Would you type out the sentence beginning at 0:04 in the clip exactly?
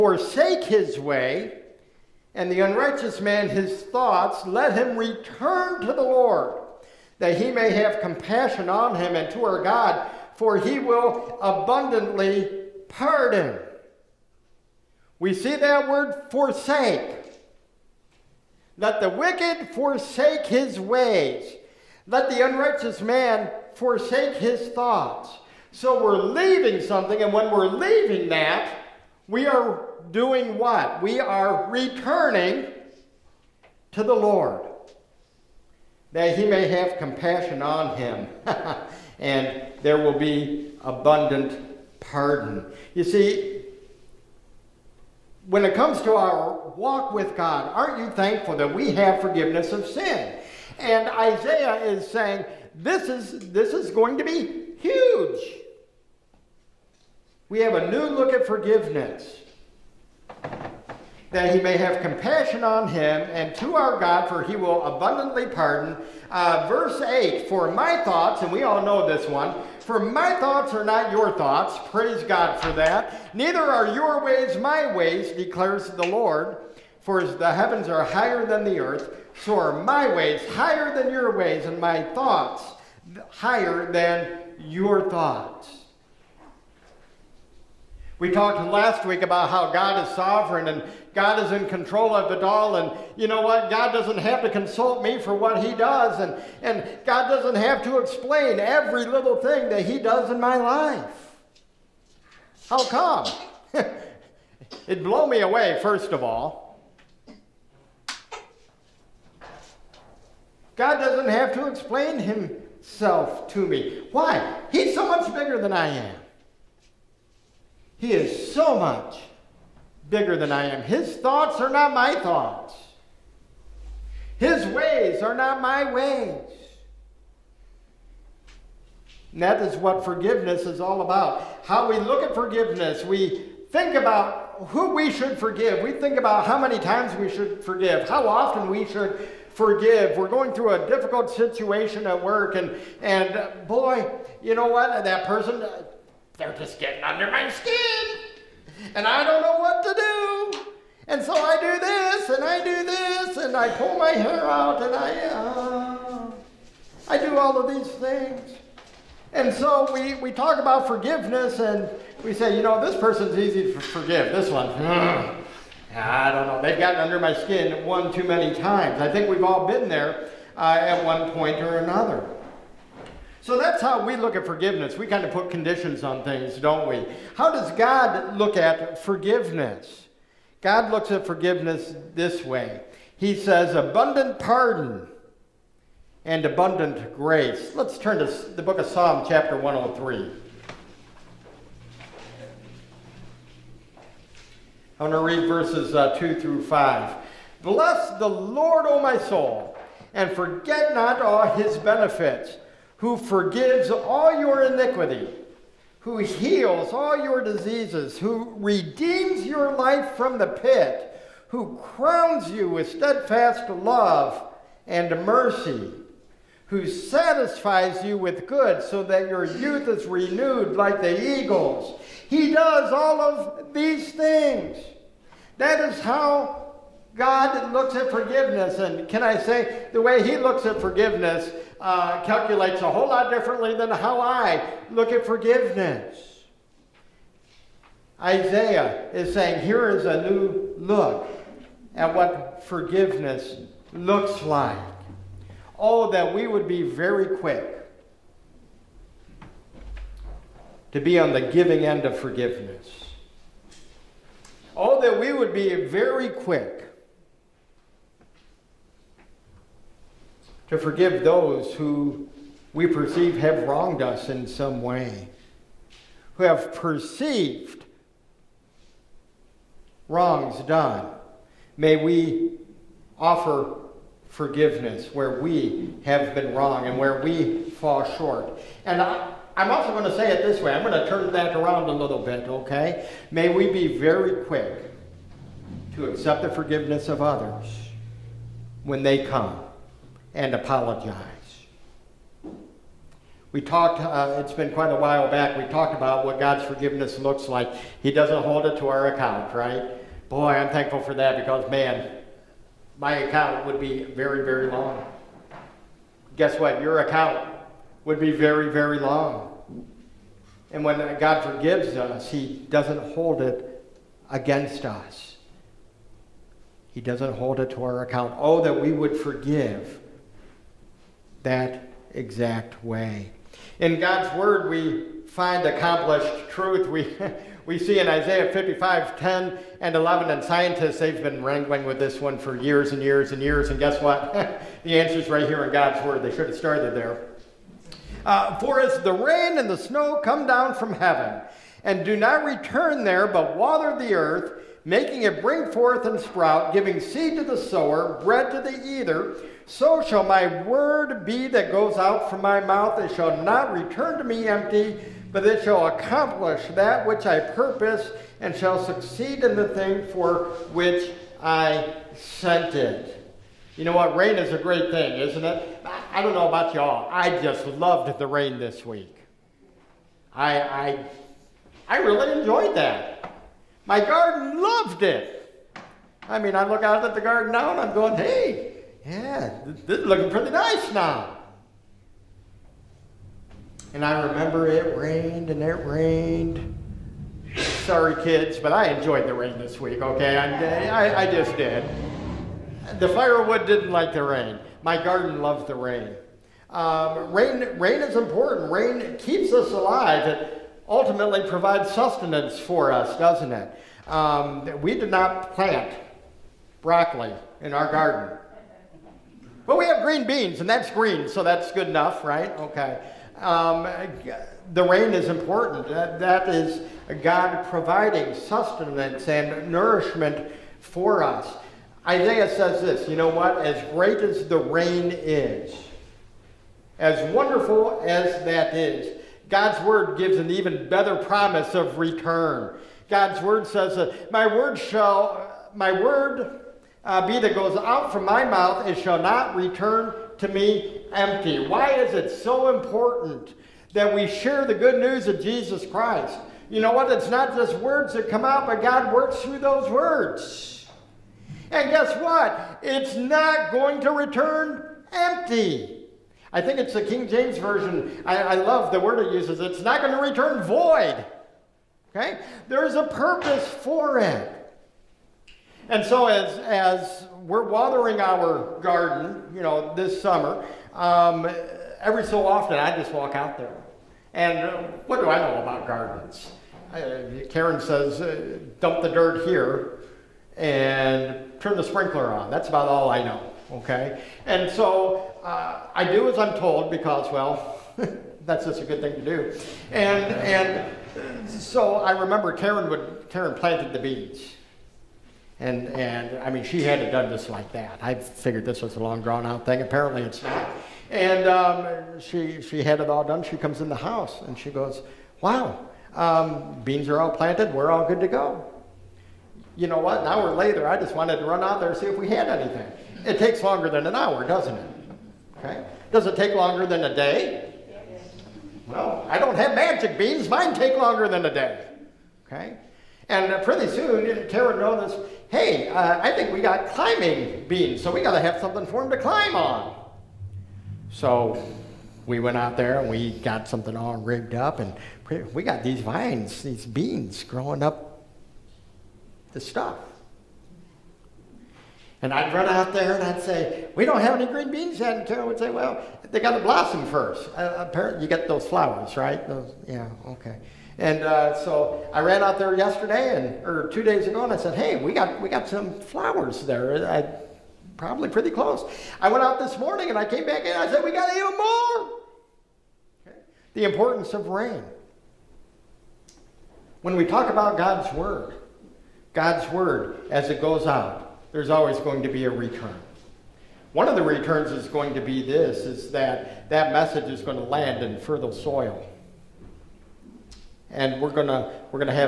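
Let him return to the Lord that he may have compassion on him and to our God, for he will abundantly pardon.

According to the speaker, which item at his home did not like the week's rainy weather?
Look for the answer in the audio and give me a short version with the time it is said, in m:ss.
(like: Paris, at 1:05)
The firewood, at 6:32.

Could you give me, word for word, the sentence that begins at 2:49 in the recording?
I think we've all been there uh, at one point or another.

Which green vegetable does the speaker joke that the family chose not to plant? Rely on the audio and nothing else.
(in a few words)
broccoli.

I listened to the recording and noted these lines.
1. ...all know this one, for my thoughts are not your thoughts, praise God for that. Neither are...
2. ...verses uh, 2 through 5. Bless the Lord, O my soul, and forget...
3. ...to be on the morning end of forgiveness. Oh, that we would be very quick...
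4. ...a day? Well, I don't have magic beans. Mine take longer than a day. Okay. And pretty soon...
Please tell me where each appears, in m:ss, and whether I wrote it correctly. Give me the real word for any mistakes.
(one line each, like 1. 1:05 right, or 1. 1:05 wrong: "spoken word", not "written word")
1. 1:08 right
2. 3:15 right
3. 4:10 wrong: "giving", not "morning"
4. 8:37 right.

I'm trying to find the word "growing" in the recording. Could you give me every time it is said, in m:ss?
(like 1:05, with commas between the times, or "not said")
8:57.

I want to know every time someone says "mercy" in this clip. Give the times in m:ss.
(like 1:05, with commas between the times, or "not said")
3:35.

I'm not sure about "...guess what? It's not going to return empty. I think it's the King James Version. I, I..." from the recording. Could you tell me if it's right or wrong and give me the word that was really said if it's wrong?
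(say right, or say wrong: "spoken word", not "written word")
right.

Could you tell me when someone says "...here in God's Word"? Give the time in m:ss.
5:35.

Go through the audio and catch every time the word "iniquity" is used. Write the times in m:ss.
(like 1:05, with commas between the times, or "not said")
3:24.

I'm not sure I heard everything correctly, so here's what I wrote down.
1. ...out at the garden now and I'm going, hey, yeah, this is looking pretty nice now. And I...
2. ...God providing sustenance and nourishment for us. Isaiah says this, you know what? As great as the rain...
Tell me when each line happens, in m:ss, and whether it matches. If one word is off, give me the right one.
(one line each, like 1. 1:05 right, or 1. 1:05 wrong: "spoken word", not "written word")
1. 6:16 right
2. 6:57 right.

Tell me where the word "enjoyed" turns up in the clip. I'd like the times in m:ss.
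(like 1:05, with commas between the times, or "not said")
6:12, 6:28.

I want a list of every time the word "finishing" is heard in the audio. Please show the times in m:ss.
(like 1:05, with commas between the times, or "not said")
not said.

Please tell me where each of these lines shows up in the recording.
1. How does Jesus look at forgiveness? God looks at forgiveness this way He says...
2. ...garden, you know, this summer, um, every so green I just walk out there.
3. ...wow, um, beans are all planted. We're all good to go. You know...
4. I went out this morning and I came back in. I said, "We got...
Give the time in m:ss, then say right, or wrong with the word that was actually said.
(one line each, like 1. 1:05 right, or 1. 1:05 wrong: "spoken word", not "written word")
1. 2:57 wrong: "God", not "Jesus"
2. 7:48 wrong: "often", not "green"
3. 8:25 right
4. 9:19 right.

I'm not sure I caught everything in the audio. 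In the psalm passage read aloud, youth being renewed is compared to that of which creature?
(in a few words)
eagles.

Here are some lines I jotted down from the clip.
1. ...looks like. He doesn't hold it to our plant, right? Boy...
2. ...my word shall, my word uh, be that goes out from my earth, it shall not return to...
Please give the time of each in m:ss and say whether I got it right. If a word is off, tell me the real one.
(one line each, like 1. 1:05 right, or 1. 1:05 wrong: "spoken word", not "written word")
1. 4:57 wrong: "account", not "plant"
2. 7:14 wrong: "mouth", not "earth".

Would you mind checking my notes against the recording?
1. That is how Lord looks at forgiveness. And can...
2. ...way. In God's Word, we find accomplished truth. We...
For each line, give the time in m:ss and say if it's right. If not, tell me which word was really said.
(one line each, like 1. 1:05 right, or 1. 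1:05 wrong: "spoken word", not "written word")
1. 3:45 wrong: "God", not "Lord"
2. 5:22 right.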